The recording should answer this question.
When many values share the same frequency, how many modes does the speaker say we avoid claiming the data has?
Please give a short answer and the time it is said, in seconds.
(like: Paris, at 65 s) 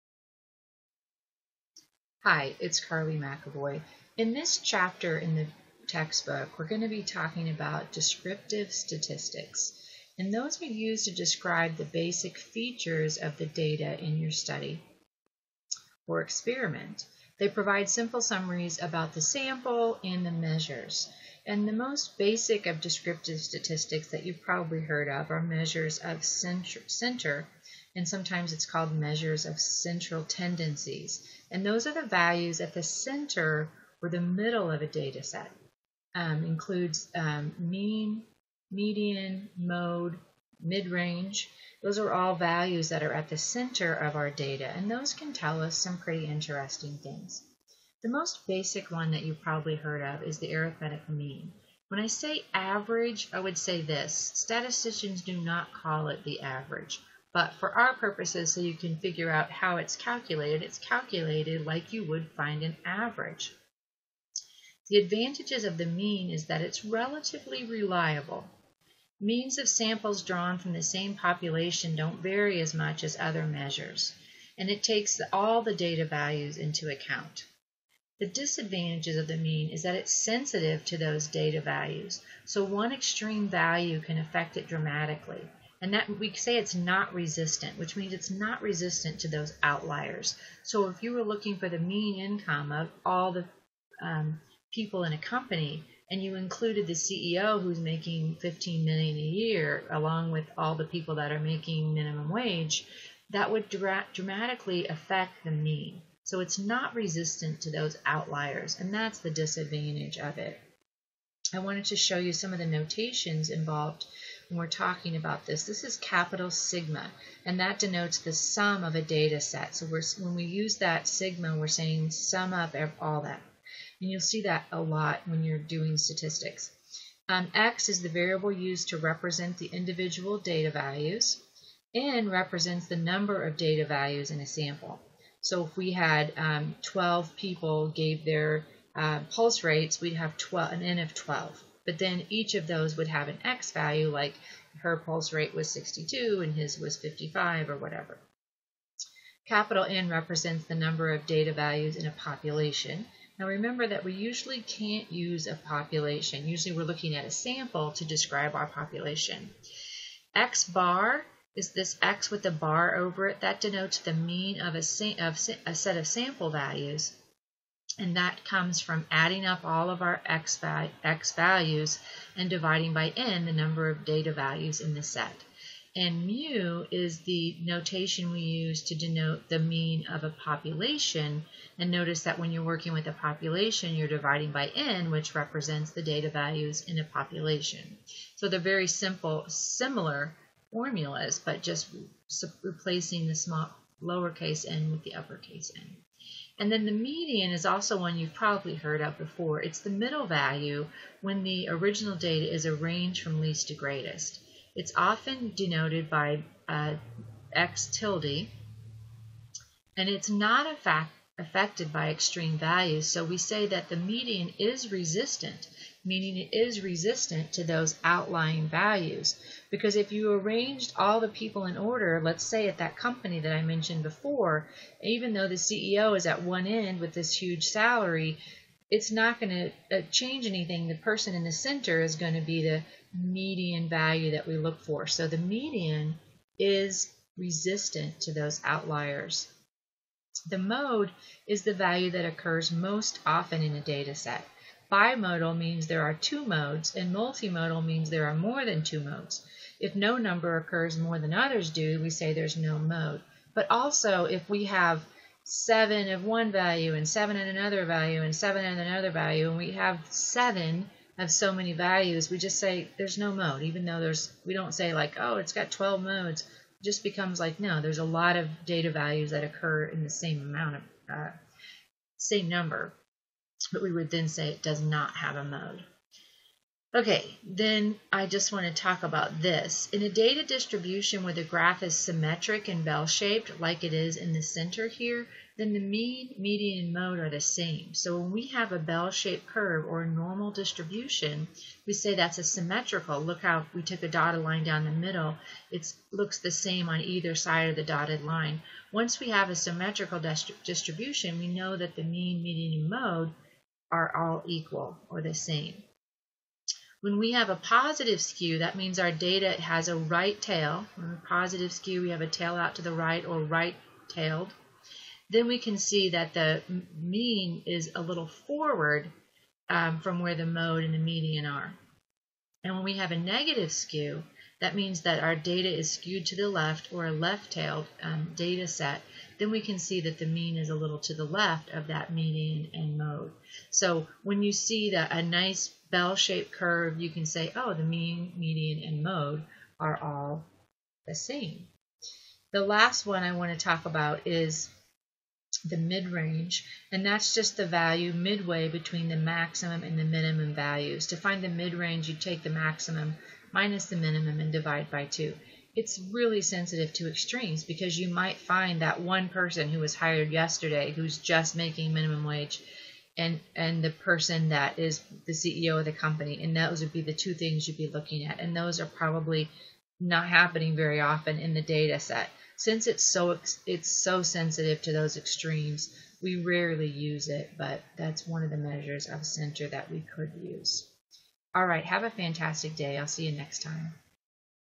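12, at 265 s.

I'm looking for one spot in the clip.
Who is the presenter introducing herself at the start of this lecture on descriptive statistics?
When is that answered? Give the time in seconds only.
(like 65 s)
2 s.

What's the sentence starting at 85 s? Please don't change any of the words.
And that we say it's not resistant, which means it's not resistant to those outliers.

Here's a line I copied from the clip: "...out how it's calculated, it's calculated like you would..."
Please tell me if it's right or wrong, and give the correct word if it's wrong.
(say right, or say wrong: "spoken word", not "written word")
right.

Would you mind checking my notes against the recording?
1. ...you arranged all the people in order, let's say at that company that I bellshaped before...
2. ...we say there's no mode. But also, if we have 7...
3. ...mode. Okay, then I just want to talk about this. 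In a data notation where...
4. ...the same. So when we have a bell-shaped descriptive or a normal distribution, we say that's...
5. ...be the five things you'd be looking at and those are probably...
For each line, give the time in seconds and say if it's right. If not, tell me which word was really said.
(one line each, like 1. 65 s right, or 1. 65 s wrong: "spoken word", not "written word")
1. 220 s wrong: "mentioned", not "bellshaped"
2. 252 s right
3. 275 s wrong: "distribution", not "notation"
4. 287 s wrong: "curve", not "descriptive"
5. 366 s wrong: "two", not "five".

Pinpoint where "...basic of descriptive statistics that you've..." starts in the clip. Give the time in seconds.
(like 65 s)
22 s.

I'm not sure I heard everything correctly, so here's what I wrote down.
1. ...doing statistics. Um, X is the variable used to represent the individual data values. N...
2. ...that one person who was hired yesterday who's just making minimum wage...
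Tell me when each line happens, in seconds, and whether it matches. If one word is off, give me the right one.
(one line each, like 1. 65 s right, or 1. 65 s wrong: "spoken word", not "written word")
1. 125 s right
2. 358 s right.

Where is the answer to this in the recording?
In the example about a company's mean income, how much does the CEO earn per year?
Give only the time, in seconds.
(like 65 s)
98 s.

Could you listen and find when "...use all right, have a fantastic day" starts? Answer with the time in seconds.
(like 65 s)
380 s.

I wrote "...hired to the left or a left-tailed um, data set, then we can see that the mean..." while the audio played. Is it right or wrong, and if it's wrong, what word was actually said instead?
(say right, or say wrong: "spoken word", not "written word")
wrong: "skewed", not "hired".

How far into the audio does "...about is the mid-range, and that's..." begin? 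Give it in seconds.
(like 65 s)
343 s.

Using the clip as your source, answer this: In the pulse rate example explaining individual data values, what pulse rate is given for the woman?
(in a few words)
62.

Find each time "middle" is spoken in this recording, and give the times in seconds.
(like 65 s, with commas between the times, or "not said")
34 s, 199 s, 294 s.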